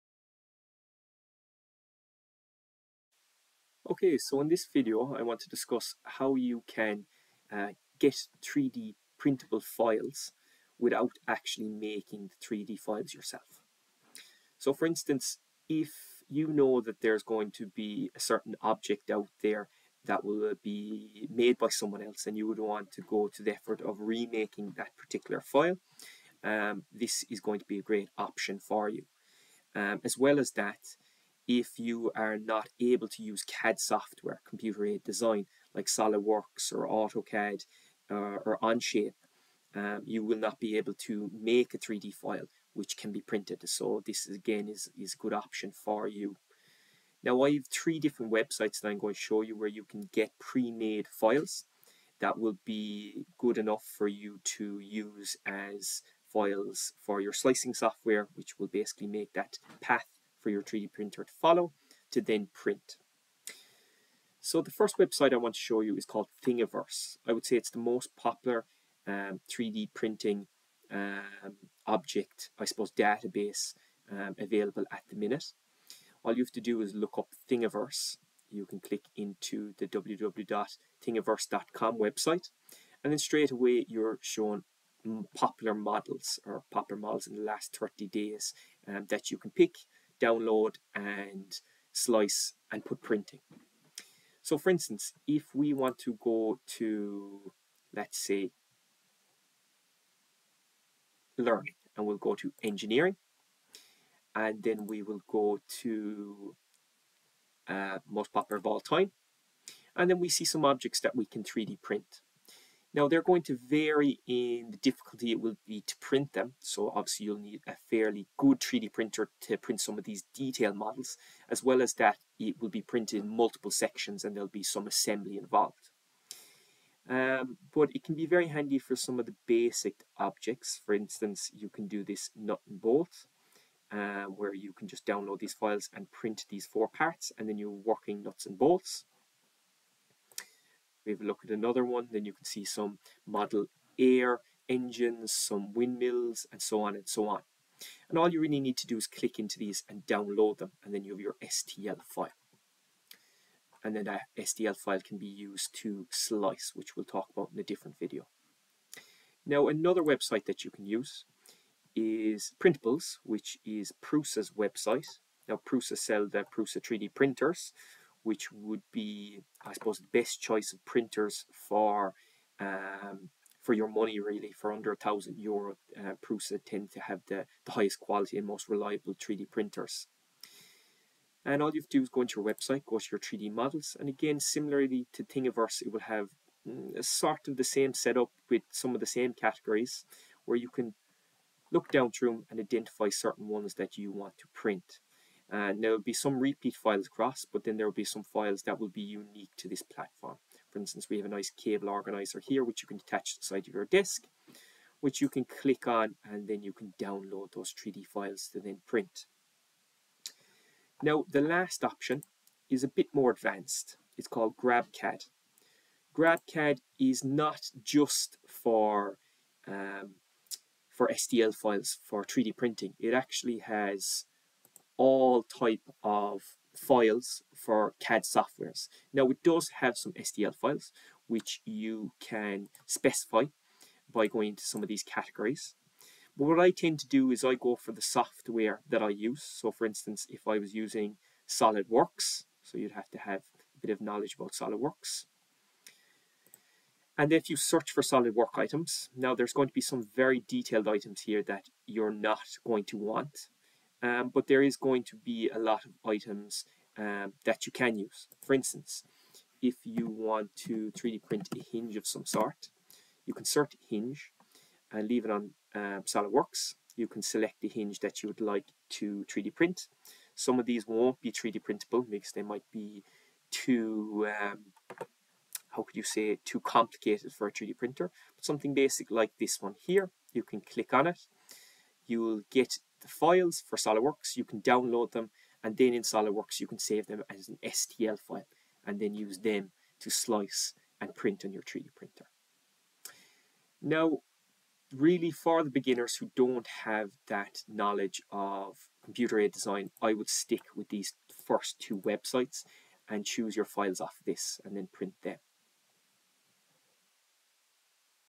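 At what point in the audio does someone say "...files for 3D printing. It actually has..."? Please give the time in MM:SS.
03:41.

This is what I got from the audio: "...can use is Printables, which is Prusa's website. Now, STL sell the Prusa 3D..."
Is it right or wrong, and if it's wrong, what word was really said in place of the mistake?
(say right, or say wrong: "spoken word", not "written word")
wrong: "Prusa", not "STL".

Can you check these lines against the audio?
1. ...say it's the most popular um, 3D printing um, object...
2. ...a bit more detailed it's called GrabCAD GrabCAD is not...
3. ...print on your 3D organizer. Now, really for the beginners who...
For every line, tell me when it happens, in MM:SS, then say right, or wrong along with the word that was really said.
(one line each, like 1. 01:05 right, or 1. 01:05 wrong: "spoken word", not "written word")
1. 01:07 right
2. 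03:32 wrong: "advanced", not "detailed"
3. 04:51 wrong: "printer", not "organizer".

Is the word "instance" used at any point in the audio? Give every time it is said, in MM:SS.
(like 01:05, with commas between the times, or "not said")
00:14, 01:34, 02:10, 03:20, 03:59, 04:18.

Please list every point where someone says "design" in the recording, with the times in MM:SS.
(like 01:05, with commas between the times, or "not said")
00:35, 04:59.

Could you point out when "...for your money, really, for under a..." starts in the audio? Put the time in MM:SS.
02:53.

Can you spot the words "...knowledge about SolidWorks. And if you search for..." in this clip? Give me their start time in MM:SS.
04:04.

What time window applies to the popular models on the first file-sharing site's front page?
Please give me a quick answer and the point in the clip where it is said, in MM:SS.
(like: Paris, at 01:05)
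Last 30 days, at 01:27.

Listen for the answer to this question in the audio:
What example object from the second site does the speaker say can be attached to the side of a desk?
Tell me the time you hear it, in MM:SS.
03:21.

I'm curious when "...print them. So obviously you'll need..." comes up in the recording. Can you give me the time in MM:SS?
01:55.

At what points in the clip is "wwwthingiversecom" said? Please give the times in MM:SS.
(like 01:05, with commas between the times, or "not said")
01:19.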